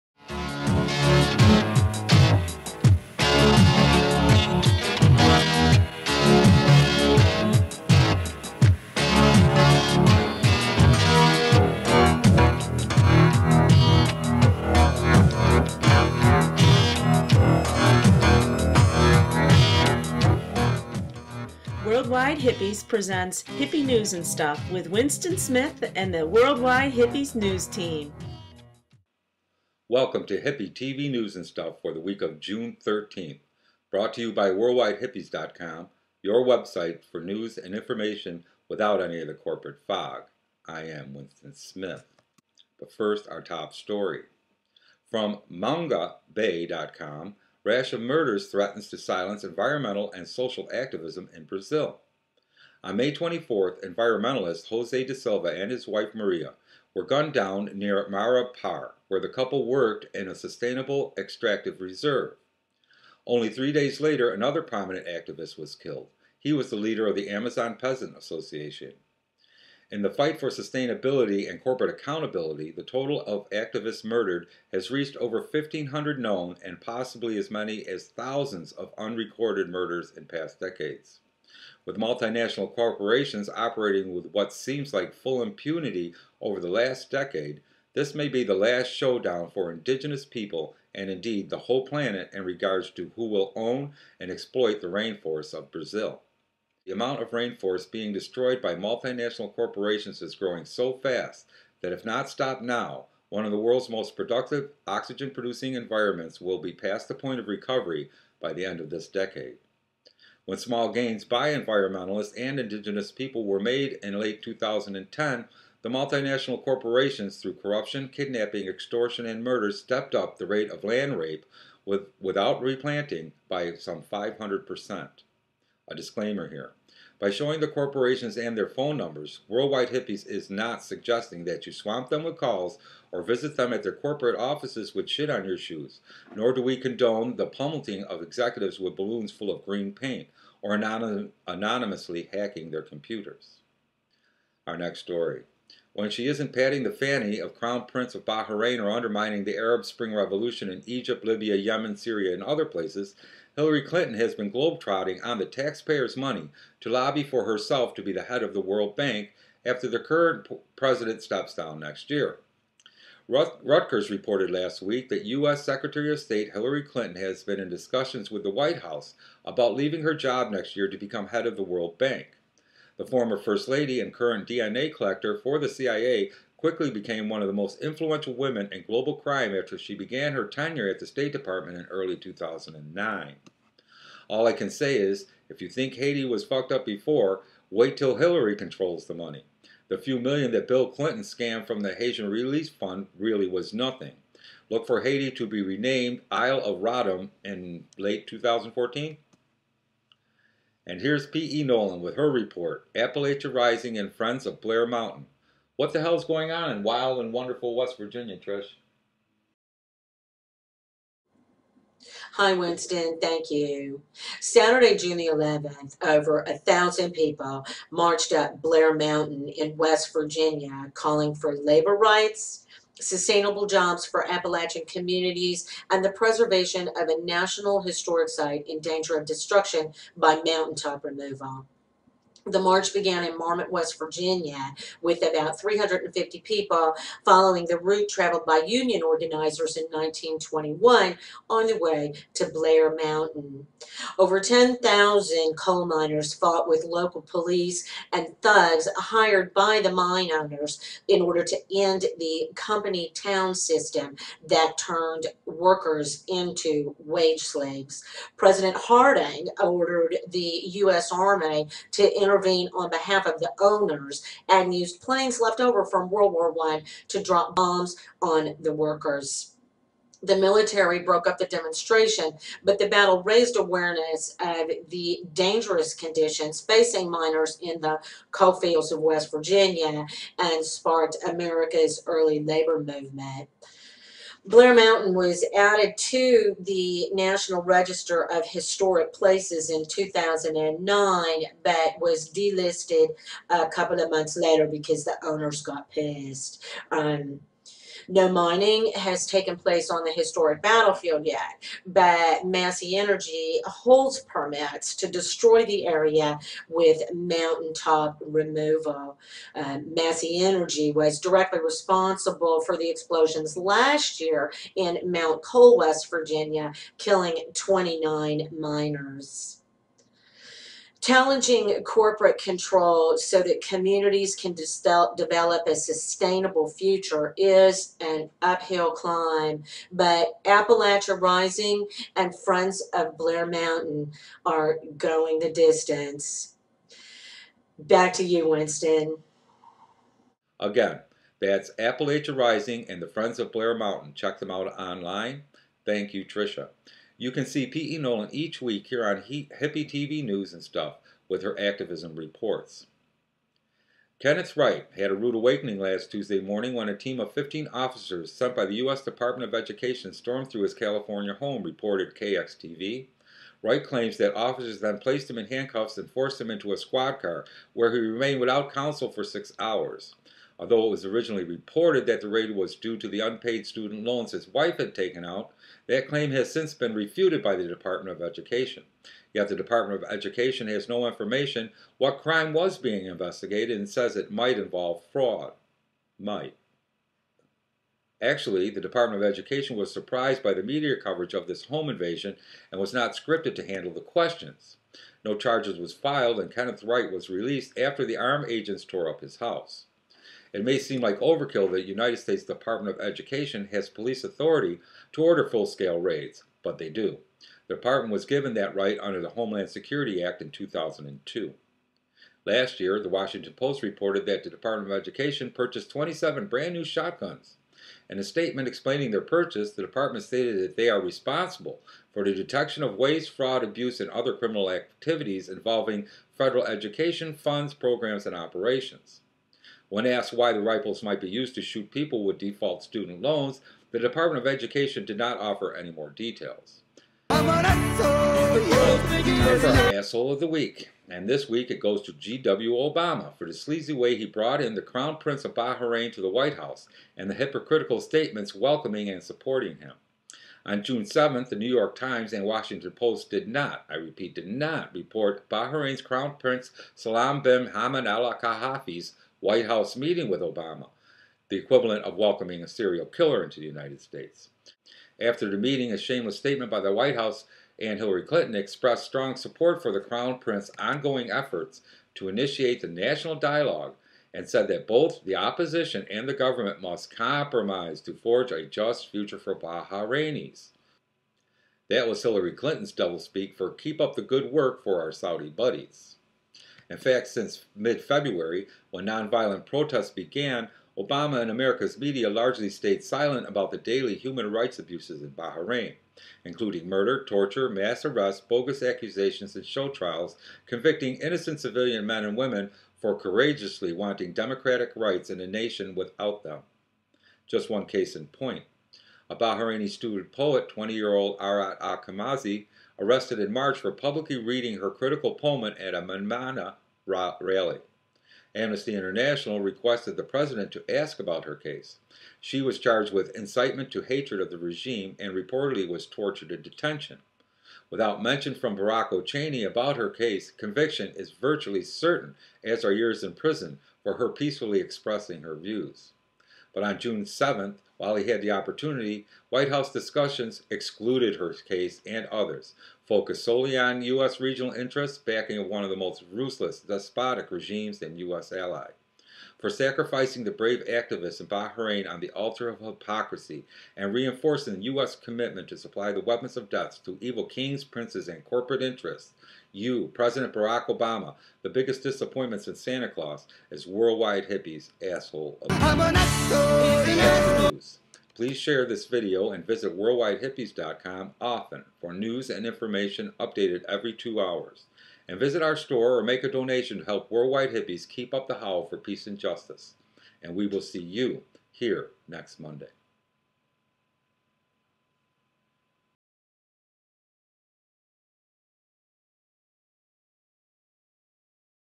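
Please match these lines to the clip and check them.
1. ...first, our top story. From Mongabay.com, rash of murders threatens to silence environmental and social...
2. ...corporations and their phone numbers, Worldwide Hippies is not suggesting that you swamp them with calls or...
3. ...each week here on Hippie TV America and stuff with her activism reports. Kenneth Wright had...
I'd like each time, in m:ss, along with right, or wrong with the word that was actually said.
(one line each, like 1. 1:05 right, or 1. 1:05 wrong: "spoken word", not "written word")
1. 0:42 right
2. 2:07 right
3. 5:48 wrong: "News", not "America".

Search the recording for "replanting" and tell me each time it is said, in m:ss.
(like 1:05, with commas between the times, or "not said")
2:02.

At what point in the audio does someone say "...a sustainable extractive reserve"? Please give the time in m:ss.
1:00.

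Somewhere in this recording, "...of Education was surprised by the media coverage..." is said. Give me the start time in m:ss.
6:29.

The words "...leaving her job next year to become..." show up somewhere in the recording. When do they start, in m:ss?
2:49.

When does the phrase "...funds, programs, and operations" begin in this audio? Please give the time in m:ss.
7:07.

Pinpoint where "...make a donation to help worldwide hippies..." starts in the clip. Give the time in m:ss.
9:36.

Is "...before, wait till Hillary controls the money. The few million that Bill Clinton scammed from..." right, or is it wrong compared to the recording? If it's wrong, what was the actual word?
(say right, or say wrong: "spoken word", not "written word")
right.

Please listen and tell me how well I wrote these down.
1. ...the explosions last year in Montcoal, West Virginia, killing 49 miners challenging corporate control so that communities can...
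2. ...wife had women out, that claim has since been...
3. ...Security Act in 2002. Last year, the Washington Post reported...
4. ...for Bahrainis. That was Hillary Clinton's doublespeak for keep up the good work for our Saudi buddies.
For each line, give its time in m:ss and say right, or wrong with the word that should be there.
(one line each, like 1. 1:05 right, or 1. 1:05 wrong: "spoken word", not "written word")
1. 5:12 wrong: "29", not "49"
2. 6:14 wrong: "taken", not "women"
3. 6:49 right
4. 7:59 right.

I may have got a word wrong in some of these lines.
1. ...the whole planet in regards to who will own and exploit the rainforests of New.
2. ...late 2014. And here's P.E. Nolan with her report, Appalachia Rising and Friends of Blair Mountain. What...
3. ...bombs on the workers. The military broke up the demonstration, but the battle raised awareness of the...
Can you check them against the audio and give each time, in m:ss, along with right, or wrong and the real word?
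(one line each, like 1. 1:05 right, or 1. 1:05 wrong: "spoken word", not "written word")
1. 1:31 wrong: "Brazil", not "New"
2. 3:17 right
3. 4:27 right.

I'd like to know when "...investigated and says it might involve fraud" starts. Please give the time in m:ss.
6:23.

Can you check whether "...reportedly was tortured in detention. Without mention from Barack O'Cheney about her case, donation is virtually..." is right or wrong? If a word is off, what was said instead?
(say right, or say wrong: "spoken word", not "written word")
wrong: "conviction", not "donation".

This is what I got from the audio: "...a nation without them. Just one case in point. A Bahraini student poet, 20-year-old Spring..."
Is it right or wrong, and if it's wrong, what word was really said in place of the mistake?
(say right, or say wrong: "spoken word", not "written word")
wrong: "Arat", not "Spring".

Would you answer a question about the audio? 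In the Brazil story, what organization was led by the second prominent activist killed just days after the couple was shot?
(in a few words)
Amazon Peasant Association.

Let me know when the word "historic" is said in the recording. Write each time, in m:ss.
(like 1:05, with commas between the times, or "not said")
3:47, 4:48, 5:00.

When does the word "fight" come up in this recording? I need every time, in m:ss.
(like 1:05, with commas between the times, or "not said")
1:10.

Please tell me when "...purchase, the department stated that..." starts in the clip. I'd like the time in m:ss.
6:59.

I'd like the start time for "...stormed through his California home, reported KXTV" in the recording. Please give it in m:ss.
6:00.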